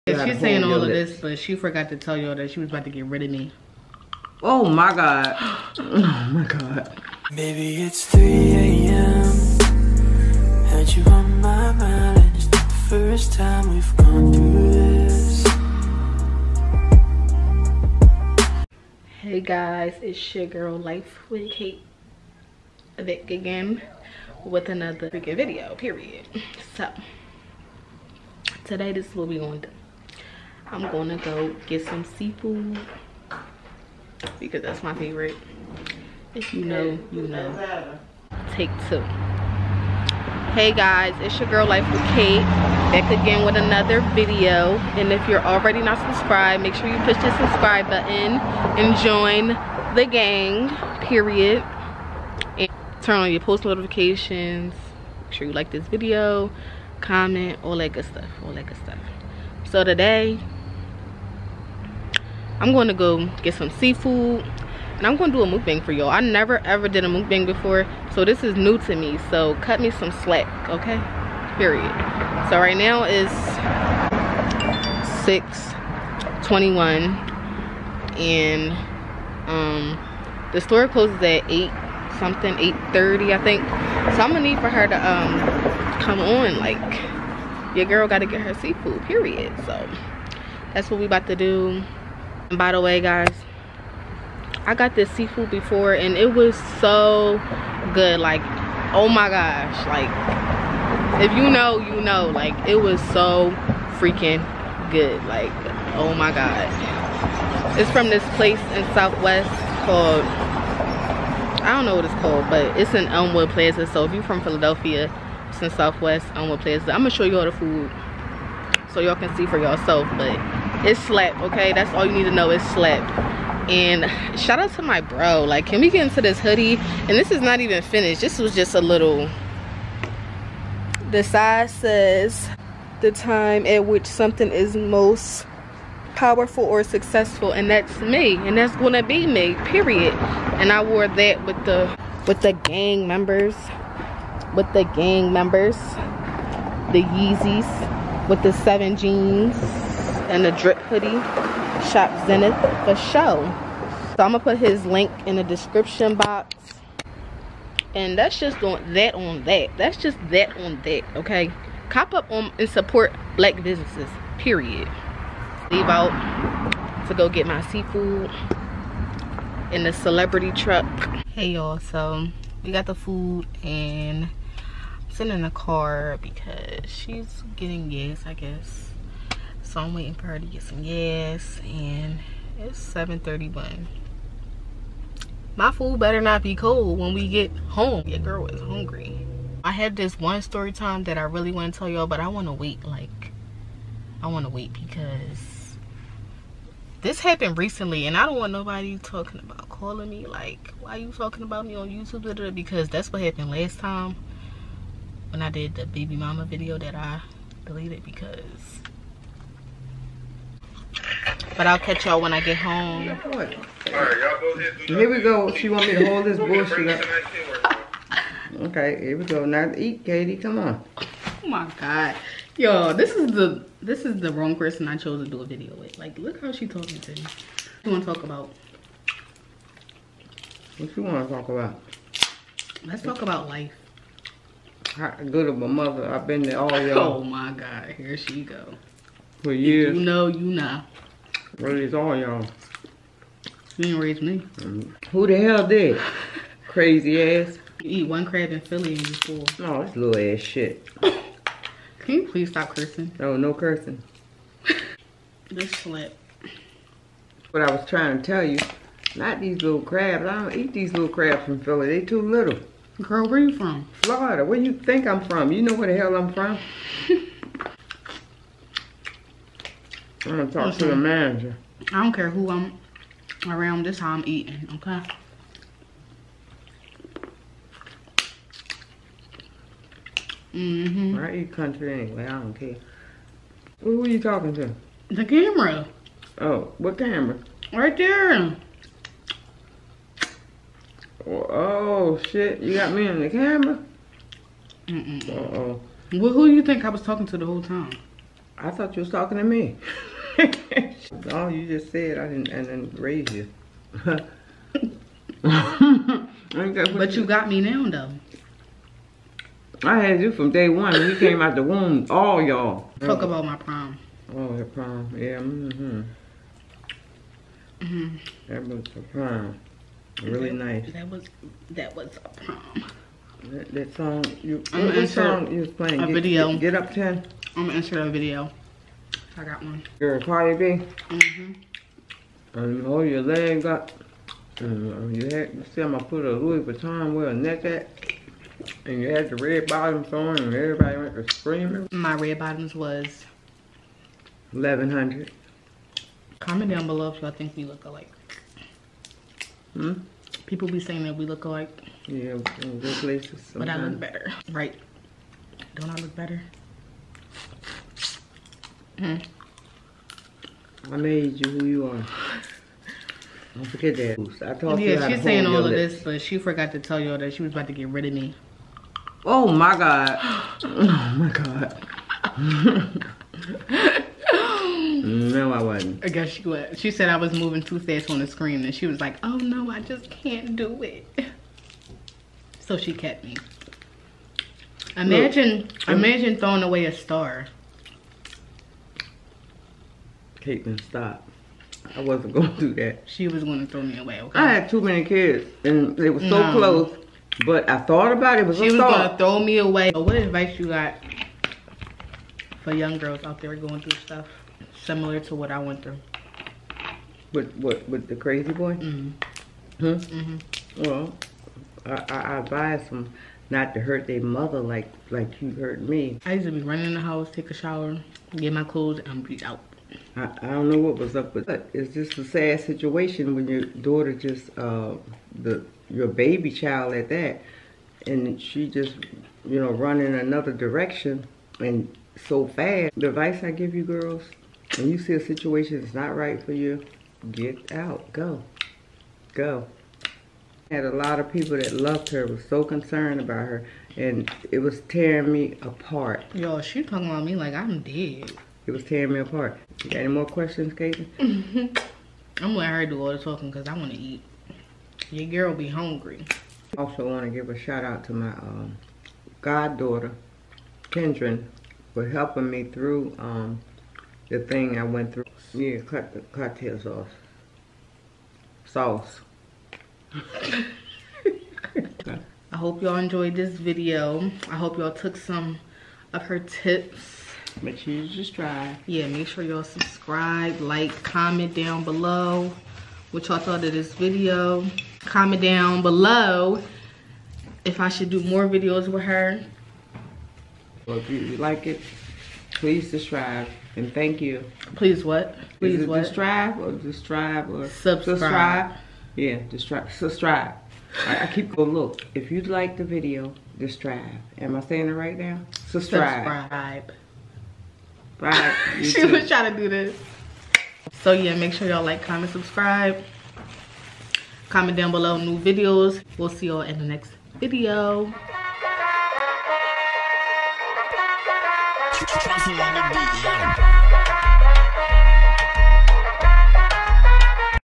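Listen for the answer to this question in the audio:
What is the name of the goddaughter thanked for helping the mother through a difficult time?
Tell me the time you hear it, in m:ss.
7:40.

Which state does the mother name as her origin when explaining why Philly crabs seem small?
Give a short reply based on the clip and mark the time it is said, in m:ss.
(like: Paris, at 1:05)
Florida, at 4:24.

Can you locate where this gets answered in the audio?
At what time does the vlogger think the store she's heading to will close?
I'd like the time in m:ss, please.
1:22.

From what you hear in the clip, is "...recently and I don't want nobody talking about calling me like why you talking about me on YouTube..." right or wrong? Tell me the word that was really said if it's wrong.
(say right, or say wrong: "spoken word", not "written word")
right.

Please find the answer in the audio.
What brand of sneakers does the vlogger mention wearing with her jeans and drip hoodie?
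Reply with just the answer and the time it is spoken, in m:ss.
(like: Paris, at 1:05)
Yeezys, at 2:27.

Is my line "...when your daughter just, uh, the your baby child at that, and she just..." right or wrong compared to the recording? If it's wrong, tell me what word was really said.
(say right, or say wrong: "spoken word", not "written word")
right.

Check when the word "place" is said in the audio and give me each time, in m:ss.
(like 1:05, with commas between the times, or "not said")
1:48, 5:52.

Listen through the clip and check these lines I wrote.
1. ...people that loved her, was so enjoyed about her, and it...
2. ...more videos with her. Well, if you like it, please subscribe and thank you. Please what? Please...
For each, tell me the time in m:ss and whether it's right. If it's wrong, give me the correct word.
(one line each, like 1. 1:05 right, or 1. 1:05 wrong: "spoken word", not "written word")
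1. 7:21 wrong: "concerned", not "enjoyed"
2. 8:08 right.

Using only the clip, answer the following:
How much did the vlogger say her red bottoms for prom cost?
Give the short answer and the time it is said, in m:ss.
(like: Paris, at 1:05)
1100, at 5:44.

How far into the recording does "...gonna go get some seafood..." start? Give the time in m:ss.
0:30.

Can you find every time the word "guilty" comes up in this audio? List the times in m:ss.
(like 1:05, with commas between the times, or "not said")
not said.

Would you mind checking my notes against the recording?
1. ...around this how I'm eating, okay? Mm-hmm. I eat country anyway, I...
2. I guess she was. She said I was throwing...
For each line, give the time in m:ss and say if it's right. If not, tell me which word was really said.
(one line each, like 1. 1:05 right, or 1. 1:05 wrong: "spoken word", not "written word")
1. 4:33 right
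2. 6:16 wrong: "moving", not "throwing".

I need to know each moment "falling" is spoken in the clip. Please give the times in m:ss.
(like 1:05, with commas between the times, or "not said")
not said.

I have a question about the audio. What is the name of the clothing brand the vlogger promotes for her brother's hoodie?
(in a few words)
Zenith.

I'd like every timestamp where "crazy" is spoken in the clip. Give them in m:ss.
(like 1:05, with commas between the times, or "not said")
4:06, 6:48.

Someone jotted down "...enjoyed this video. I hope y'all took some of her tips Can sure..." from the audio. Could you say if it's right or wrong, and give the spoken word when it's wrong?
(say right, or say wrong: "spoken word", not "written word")
wrong: "Make", not "Can".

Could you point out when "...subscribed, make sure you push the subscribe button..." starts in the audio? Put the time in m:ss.
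0:45.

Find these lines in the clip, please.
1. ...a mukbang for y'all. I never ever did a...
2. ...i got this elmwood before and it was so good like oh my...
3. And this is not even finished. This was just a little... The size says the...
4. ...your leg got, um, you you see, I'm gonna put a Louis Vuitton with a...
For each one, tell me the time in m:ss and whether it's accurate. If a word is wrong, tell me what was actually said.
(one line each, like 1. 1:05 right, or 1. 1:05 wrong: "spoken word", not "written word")
1. 1:05 right
2. 1:34 wrong: "seafood", not "elmwood"
3. 2:06 right
4. 5:33 right.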